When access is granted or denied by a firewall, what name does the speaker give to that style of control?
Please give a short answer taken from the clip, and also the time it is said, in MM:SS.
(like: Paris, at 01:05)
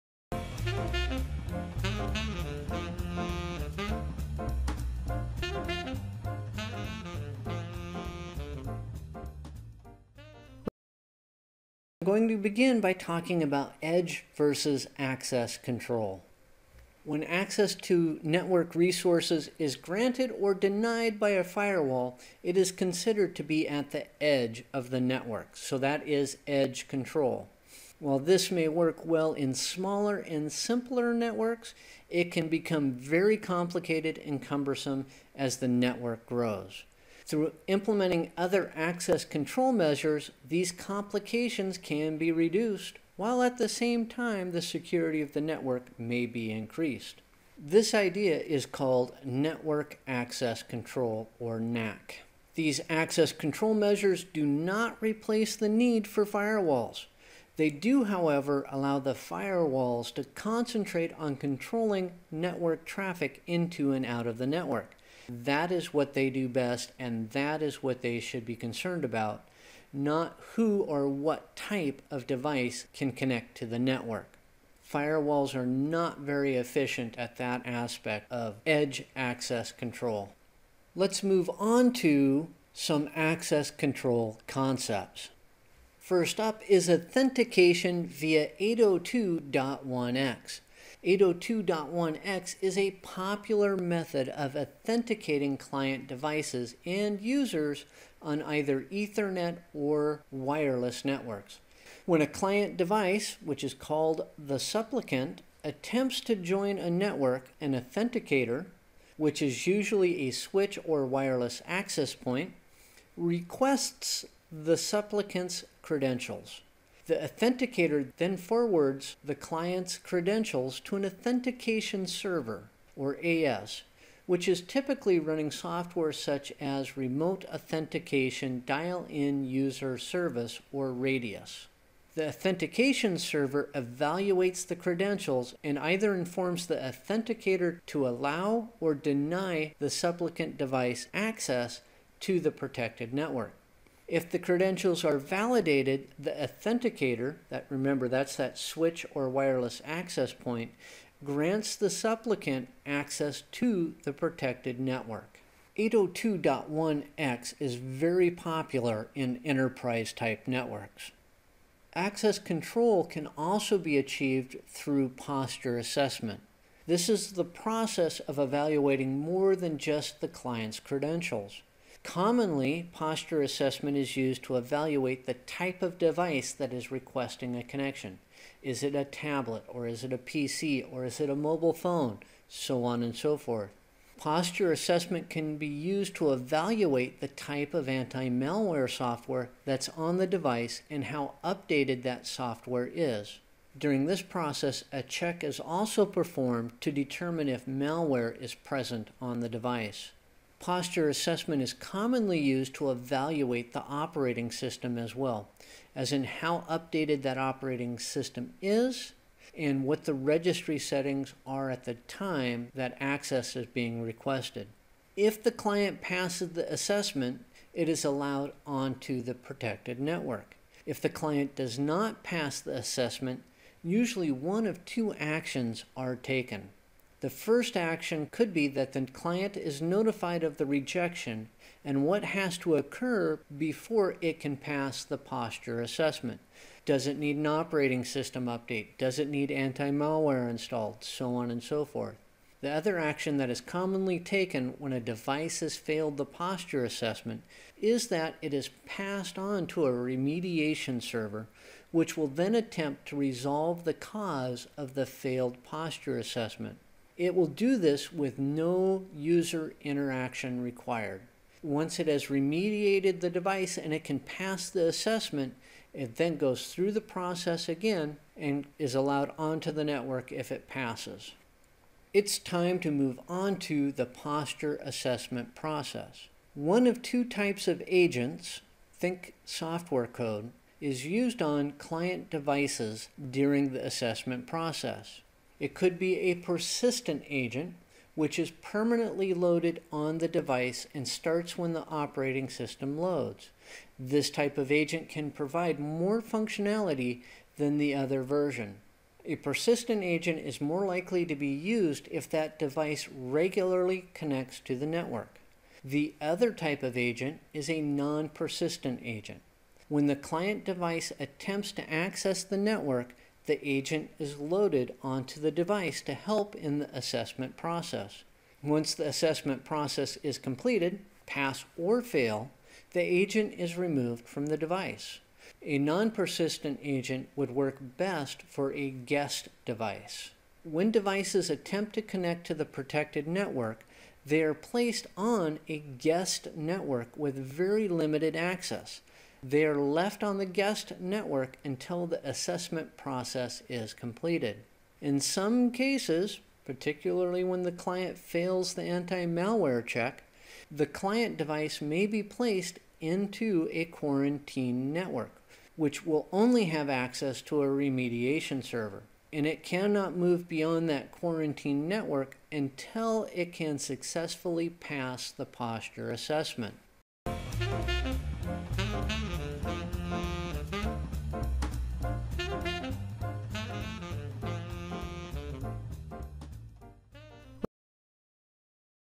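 edge control, at 00:26.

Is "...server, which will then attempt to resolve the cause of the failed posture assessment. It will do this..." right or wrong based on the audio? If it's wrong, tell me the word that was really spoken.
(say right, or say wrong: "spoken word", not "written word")
right.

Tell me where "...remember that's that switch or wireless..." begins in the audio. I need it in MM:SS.
02:27.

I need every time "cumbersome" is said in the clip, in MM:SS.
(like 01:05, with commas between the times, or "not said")
00:34.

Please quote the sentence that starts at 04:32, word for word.
It's time to move on to the posture assessment process.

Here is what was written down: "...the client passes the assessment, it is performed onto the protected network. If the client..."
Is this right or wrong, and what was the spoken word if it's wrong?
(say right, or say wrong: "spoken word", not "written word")
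wrong: "allowed", not "performed".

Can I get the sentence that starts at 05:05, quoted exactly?
The other type of agent is a non-persistent agent.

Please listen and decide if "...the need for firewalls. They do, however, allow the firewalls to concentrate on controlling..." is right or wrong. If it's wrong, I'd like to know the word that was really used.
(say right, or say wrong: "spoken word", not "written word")
right.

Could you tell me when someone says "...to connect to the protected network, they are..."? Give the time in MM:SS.
05:31.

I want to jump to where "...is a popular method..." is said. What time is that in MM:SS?
01:32.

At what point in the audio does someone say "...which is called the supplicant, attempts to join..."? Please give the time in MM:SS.
01:43.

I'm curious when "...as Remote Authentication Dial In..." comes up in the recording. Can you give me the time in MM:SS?
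02:06.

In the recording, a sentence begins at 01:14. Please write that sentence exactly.
Firewalls are not very efficient at that aspect of edge access control.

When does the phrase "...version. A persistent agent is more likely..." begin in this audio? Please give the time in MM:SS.
04:58.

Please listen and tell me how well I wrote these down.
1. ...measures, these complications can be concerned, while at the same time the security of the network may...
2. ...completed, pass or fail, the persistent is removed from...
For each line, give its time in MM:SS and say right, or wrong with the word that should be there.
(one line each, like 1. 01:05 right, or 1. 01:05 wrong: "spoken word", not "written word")
1. 00:39 wrong: "reduced", not "concerned"
2. 05:20 wrong: "agent", not "persistent".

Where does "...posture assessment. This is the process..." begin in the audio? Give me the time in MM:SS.
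02:45.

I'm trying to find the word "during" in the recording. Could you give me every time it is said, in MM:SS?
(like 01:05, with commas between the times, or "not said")
03:13, 04:43.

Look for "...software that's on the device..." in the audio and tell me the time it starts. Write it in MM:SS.
03:08.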